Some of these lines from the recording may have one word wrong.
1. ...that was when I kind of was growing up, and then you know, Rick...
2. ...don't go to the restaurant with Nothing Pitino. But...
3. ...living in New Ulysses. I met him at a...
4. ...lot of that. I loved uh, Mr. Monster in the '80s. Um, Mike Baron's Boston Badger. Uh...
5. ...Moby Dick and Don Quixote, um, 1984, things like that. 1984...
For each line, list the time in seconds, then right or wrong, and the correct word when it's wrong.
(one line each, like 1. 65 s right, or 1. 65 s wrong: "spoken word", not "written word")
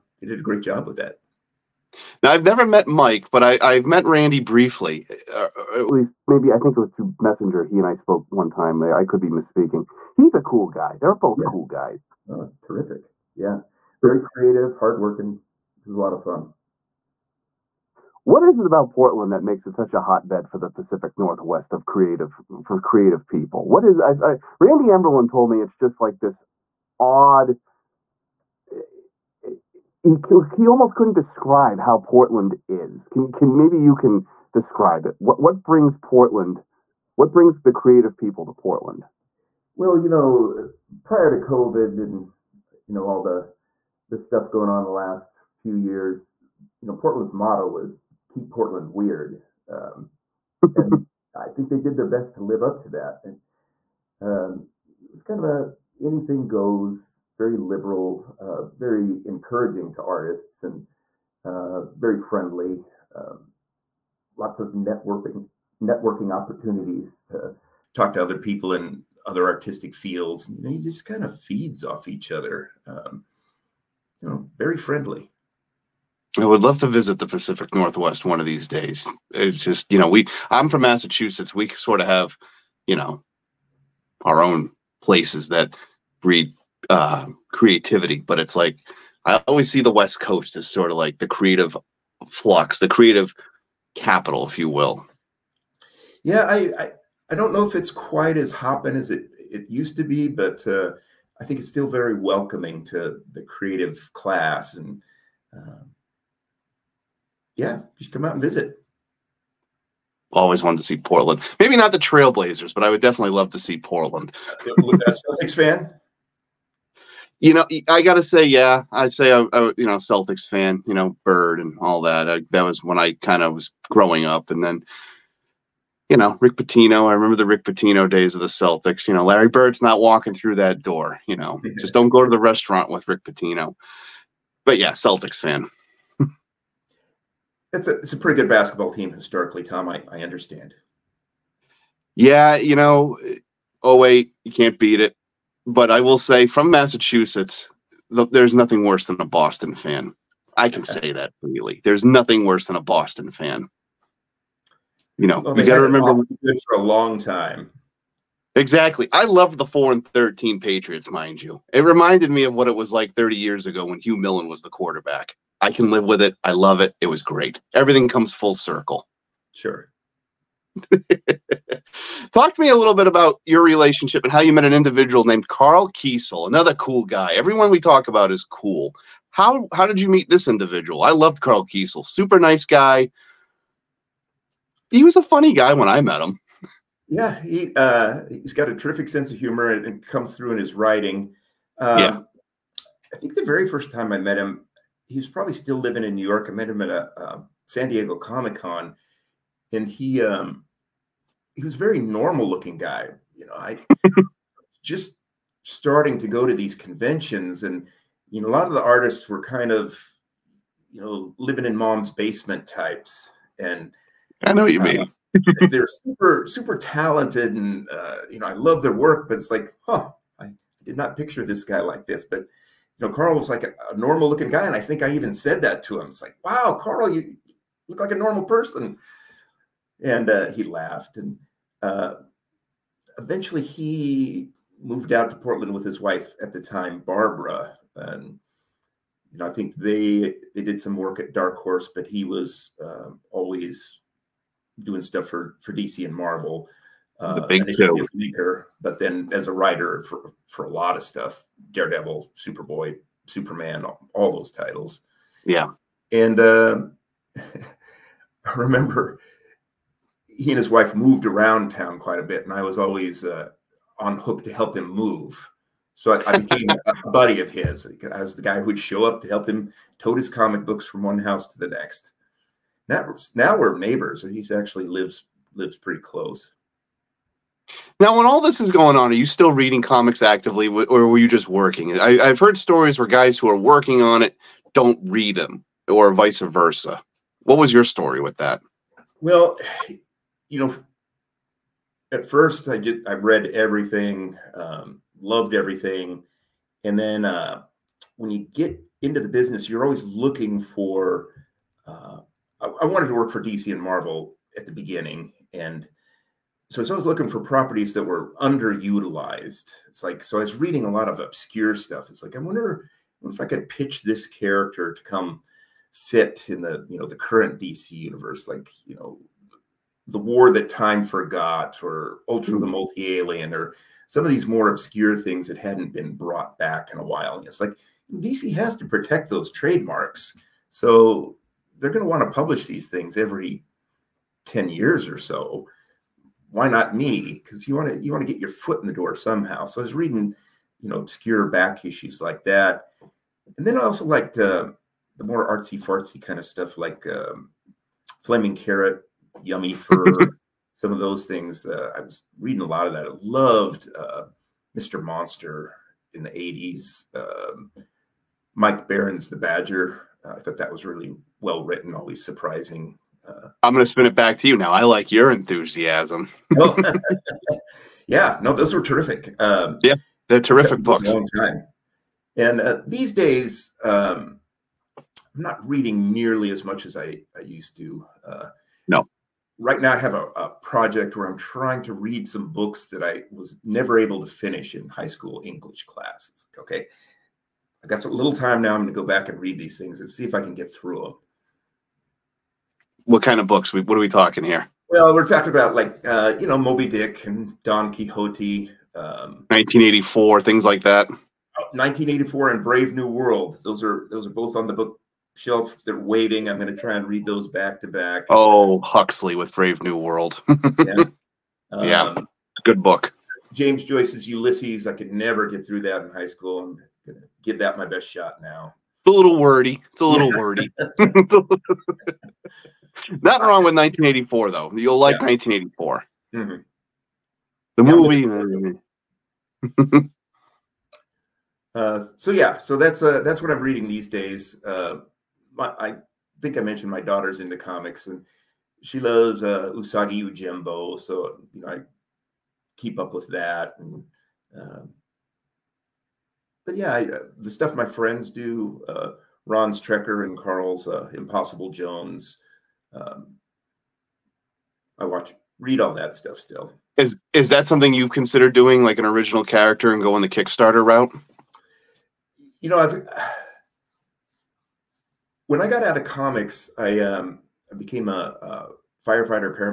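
1. 122 s right
2. 131 s wrong: "Rick", not "Nothing"
3. 195 s wrong: "York", not "Ulysses"
4. 352 s wrong: "The", not "Boston"
5. 396 s right.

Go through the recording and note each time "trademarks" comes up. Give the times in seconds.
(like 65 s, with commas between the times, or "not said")
329 s.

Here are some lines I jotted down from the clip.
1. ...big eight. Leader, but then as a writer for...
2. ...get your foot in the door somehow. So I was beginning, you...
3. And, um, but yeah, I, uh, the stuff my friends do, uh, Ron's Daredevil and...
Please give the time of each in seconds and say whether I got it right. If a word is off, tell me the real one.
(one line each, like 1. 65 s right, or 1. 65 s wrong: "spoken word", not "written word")
1. 247 s wrong: "two", not "eight"
2. 338 s wrong: "reading", not "beginning"
3. 443 s wrong: "Trekker", not "Daredevil".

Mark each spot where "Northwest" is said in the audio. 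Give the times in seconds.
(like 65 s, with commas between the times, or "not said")
21 s, 77 s.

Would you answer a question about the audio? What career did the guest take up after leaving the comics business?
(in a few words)
firefighter.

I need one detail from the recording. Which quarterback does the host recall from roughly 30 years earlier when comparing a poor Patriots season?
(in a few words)
Hugh Millen.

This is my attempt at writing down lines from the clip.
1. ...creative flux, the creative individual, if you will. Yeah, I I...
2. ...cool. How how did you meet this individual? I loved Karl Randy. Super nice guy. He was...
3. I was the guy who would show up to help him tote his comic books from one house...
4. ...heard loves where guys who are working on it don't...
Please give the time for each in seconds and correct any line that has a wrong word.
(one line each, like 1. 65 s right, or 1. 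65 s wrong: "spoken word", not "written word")
1. 91 s wrong: "capital", not "individual"
2. 178 s wrong: "Kesel", not "Randy"
3. 268 s right
4. 282 s wrong: "stories", not "loves".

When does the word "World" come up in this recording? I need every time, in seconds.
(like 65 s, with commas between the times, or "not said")
403 s, 409 s.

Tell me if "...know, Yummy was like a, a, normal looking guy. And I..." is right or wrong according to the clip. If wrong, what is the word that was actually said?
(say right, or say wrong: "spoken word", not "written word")
wrong: "Karl", not "Yummy".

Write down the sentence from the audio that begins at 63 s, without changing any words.
Um, lots of networking networking opportunities to talk to other people in other artistic fields.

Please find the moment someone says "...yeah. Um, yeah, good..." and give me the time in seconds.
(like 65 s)
410 s.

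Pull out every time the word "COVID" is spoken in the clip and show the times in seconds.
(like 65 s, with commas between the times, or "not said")
41 s.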